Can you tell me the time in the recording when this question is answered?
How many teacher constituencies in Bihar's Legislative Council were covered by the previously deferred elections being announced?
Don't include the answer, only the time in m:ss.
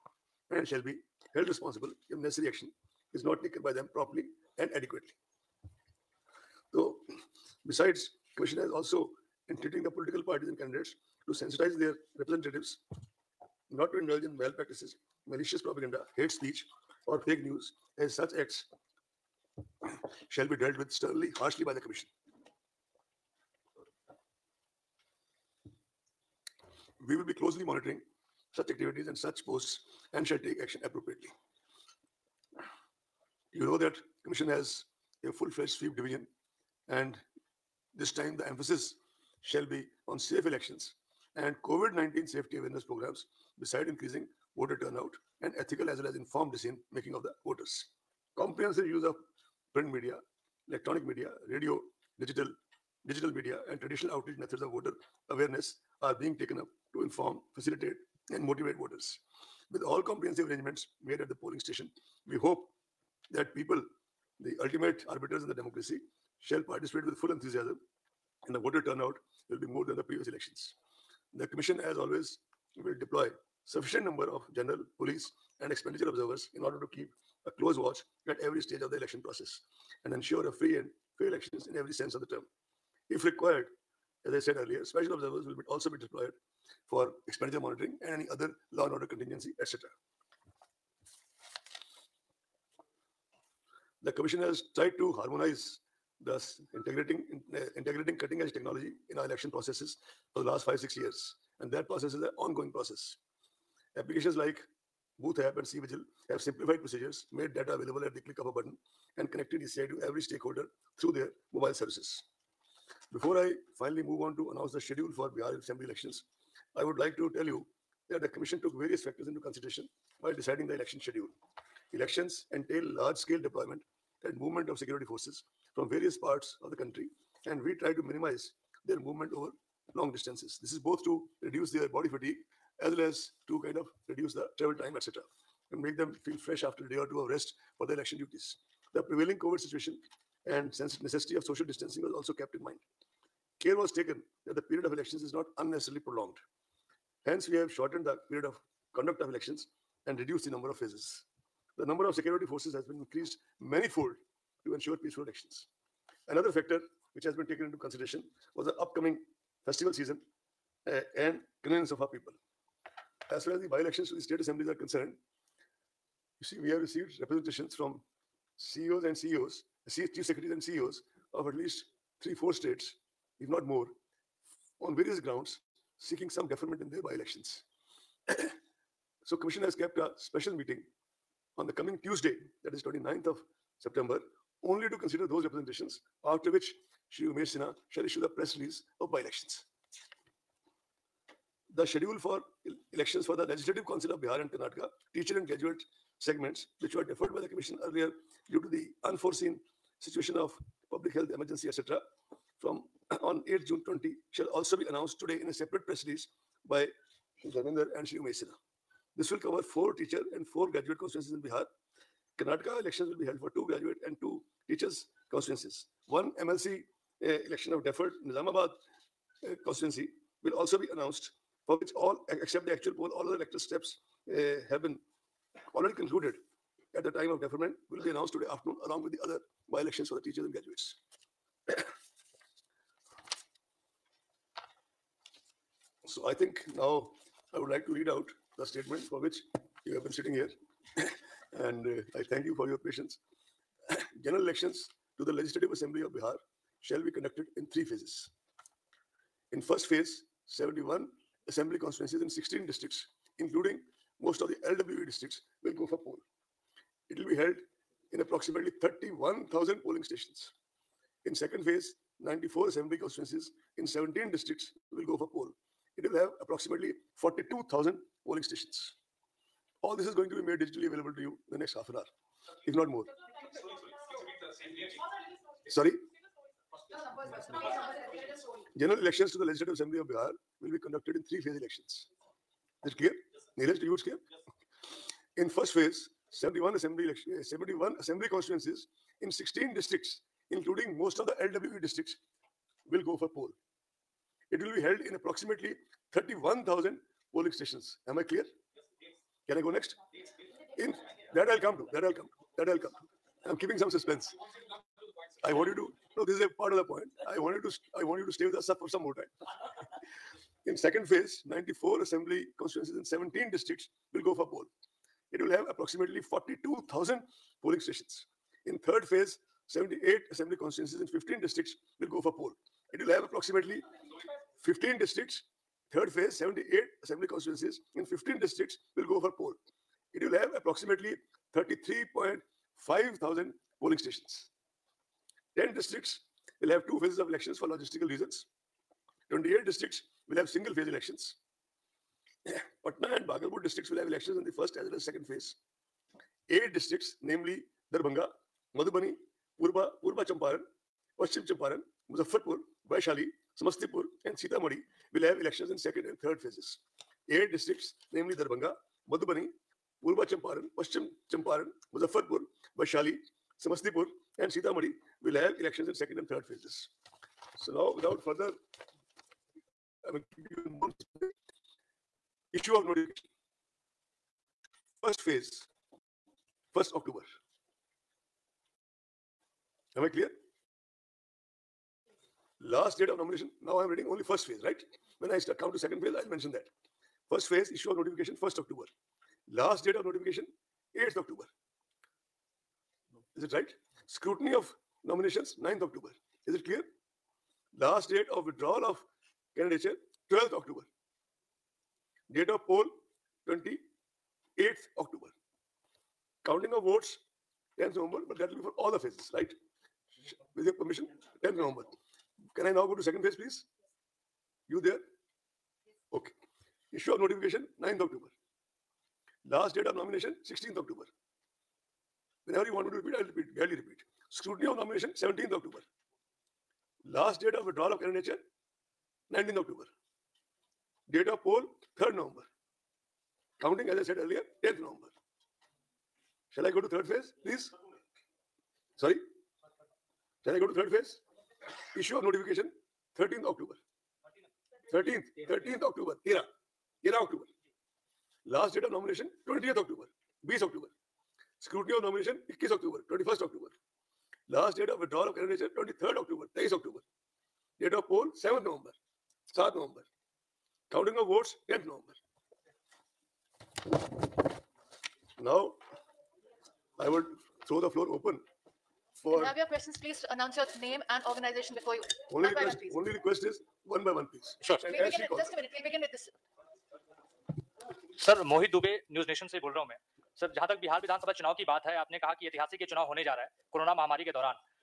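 3:29.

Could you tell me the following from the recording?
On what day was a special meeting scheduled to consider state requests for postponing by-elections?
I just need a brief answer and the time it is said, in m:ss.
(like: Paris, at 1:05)
29 September, at 3:02.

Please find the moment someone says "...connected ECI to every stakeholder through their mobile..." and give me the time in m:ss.
1:49.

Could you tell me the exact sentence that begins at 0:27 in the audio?
We will be closely monitoring such activities and such posts and shall take action appropriately.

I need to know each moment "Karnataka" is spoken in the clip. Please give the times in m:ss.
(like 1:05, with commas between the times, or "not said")
3:14, 3:32.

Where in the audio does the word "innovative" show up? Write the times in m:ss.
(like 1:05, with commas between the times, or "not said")
not said.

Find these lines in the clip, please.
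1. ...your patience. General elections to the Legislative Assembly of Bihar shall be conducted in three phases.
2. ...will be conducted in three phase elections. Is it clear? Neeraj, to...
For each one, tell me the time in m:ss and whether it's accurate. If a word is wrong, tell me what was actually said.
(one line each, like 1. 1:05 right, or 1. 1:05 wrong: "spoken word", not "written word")
1. 4:02 right
2. 4:40 right.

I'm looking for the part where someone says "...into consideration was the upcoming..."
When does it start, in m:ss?
2:37.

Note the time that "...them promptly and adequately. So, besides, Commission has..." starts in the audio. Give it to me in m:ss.
0:03.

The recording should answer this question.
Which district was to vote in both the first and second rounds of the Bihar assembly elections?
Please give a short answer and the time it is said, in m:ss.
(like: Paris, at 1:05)
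Patna, at 5:42.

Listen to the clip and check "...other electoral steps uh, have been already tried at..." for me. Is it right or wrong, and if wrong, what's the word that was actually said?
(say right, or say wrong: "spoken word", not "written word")
wrong: "concluded", not "tried".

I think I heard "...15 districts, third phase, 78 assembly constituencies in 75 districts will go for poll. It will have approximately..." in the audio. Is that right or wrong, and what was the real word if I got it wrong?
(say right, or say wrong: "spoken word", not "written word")
wrong: "15", not "75".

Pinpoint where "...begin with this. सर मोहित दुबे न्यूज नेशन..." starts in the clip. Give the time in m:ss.
7:55.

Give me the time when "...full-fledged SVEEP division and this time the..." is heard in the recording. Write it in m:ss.
0:35.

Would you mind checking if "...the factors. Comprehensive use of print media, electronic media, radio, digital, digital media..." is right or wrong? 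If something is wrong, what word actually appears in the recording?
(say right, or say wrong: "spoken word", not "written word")
wrong: "voters", not "factors".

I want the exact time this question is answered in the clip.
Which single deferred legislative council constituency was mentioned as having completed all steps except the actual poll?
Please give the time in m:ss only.
3:38.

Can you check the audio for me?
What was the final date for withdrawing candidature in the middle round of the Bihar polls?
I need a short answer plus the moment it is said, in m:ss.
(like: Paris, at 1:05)
19 October, at 7:09.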